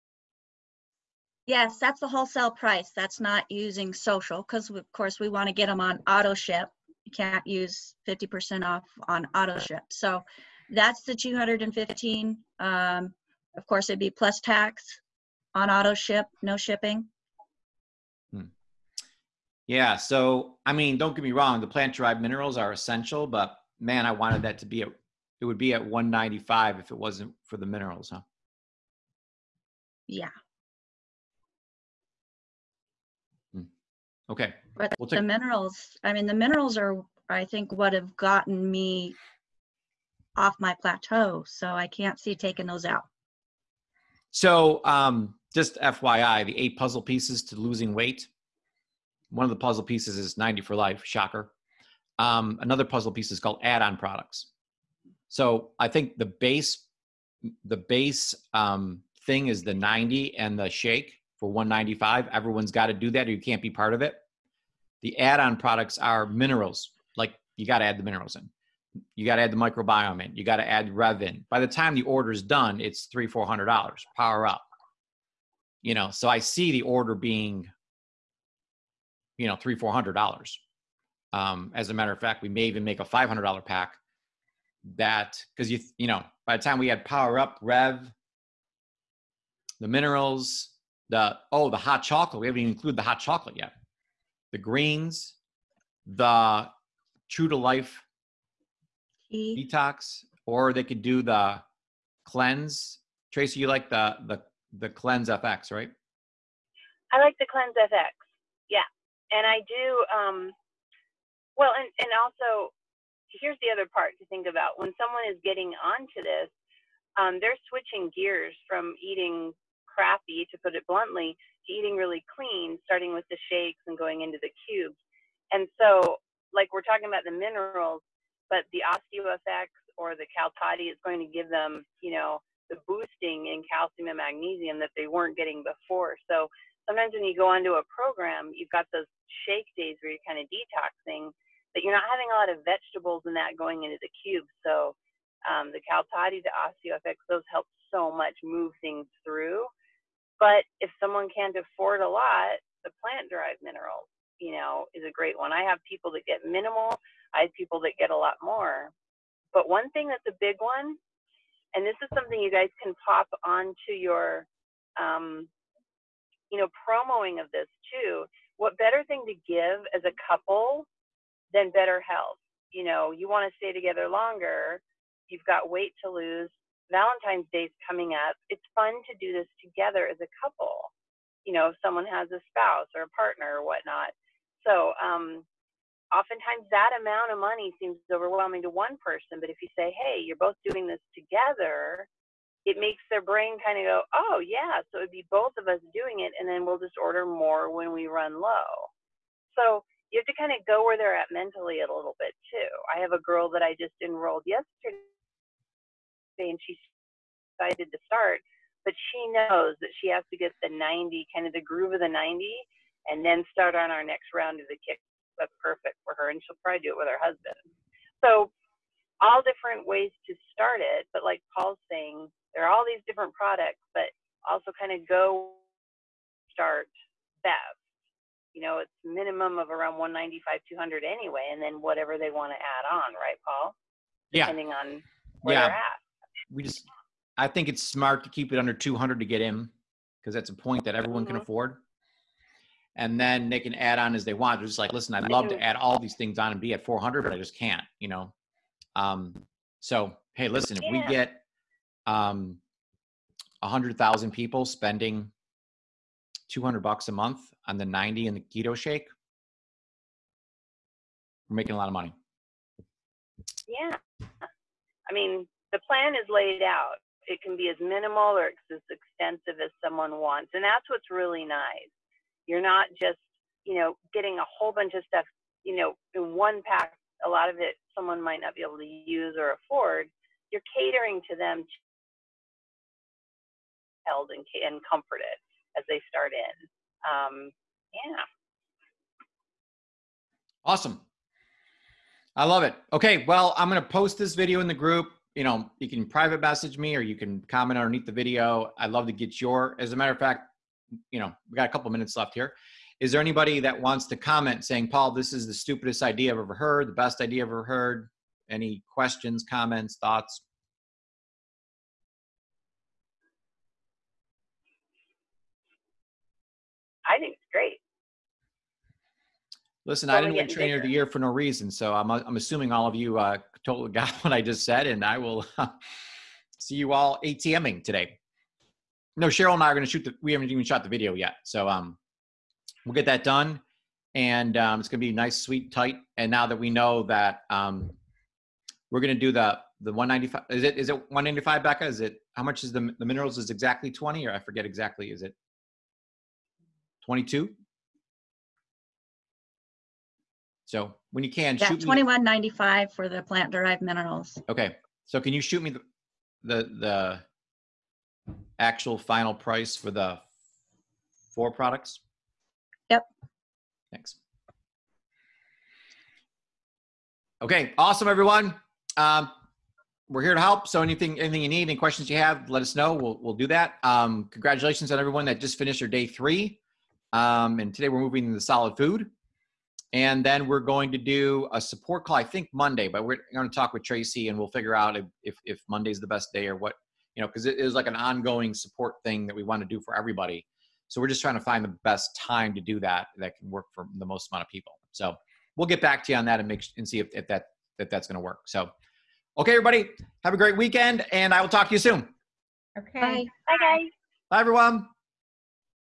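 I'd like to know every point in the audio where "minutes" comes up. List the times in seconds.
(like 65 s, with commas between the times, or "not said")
301 s.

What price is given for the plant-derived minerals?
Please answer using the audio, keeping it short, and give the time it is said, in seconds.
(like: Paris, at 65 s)
$21.95, at 351 s.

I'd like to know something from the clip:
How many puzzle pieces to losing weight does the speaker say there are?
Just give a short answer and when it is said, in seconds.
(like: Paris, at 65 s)
8, at 46 s.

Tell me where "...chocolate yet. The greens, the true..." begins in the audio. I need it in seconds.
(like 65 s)
93 s.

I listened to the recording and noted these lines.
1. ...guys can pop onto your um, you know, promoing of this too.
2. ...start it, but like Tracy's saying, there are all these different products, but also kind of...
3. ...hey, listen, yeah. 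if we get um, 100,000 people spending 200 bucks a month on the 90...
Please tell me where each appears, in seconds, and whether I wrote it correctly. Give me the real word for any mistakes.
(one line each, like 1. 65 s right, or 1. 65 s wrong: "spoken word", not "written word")
1. 162 s right
2. 220 s wrong: "Paul", not "Tracy"
3. 250 s right.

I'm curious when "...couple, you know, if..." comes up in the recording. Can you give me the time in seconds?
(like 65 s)
180 s.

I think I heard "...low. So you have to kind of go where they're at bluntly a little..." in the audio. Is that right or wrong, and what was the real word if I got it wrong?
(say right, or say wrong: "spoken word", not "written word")
wrong: "mentally", not "bluntly".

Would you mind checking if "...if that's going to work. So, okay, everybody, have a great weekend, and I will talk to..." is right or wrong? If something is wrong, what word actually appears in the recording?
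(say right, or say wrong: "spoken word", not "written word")
right.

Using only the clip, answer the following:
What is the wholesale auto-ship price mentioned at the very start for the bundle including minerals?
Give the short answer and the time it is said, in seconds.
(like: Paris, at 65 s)
215, at 10 s.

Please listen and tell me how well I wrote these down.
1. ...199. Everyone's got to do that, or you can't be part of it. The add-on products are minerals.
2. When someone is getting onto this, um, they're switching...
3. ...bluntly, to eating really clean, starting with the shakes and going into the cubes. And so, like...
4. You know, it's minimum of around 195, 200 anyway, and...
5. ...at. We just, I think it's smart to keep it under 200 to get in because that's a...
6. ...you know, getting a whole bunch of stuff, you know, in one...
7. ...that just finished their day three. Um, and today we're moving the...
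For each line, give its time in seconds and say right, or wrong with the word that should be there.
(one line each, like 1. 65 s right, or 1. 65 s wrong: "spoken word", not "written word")
1. 61 s wrong: "195", not "199"
2. 114 s right
3. 120 s right
4. 228 s right
5. 235 s right
6. 273 s right
7. 375 s right.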